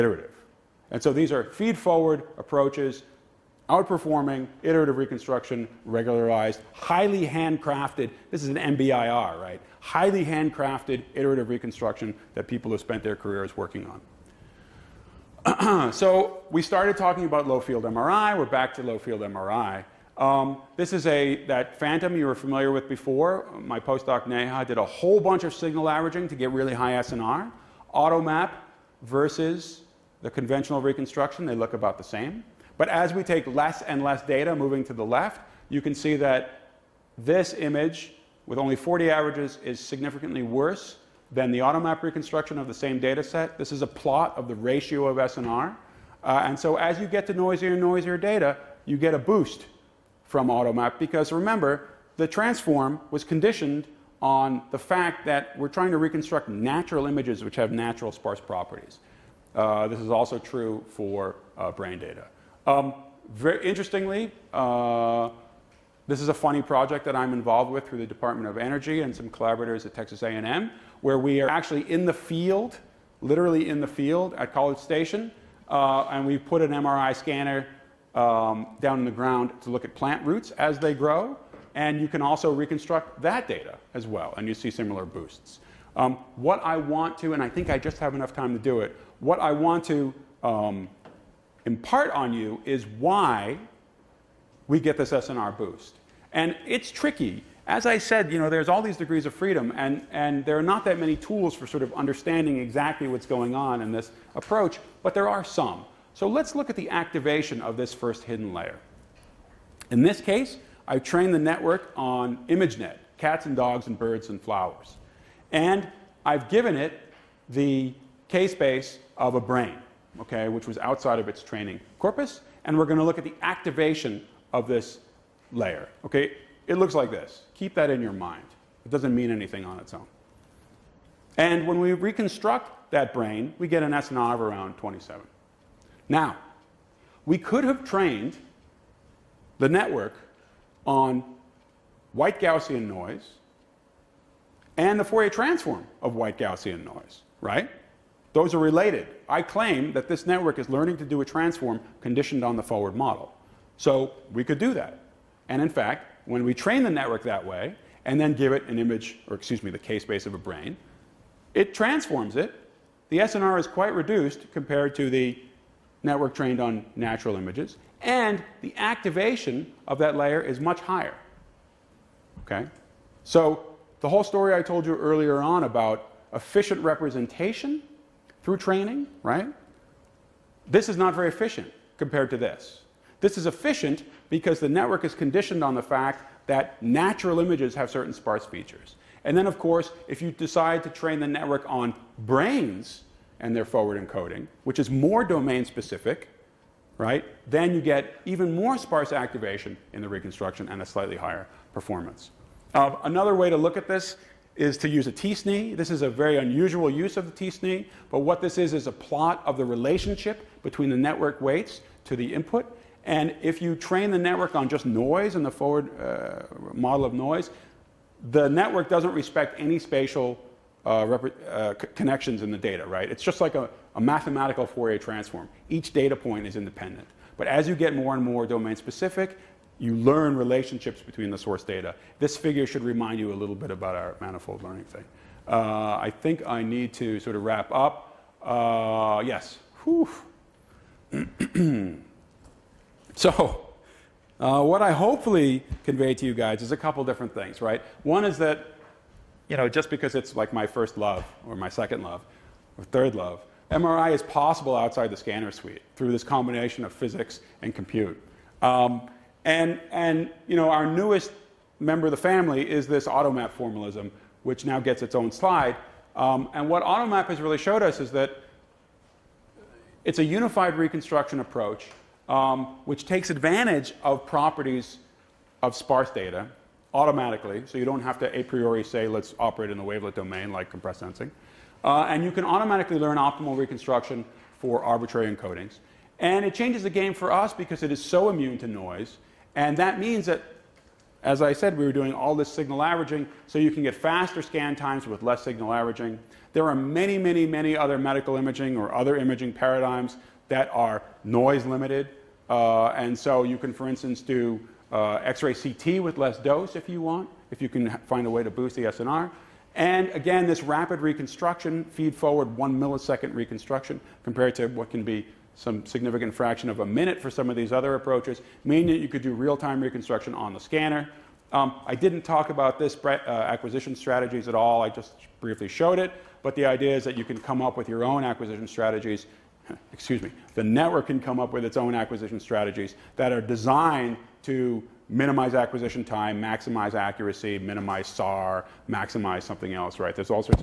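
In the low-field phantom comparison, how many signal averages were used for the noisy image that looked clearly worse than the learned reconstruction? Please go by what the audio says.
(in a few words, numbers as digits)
40.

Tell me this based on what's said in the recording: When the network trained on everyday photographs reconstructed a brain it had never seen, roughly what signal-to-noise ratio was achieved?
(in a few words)
27.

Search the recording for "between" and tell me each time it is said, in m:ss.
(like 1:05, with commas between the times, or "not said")
3:30, 3:51.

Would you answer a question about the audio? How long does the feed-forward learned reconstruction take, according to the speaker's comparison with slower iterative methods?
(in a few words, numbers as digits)
1 millisecond.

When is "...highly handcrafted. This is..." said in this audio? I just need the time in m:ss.
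0:06.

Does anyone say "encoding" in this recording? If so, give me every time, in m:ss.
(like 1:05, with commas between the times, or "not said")
3:14, 4:45.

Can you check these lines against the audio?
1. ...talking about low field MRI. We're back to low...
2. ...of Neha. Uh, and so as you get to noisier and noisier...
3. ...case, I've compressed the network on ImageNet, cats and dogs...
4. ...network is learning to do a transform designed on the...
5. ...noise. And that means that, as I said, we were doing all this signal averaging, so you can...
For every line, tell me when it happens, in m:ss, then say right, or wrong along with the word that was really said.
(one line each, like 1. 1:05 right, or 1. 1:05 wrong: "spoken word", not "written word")
1. 0:16 right
2. 0:45 wrong: "SNR", not "Neha"
3. 1:50 wrong: "trained", not "compressed"
4. 2:30 wrong: "conditioned", not "designed"
5. 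4:48 right.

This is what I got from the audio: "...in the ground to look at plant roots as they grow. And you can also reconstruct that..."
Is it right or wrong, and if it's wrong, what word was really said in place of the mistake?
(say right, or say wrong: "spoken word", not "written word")
right.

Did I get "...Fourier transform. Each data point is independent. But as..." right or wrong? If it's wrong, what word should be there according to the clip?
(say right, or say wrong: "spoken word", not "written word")
right.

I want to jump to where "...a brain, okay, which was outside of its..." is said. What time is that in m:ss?
1:59.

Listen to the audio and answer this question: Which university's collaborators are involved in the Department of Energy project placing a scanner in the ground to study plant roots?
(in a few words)
Texas A&M.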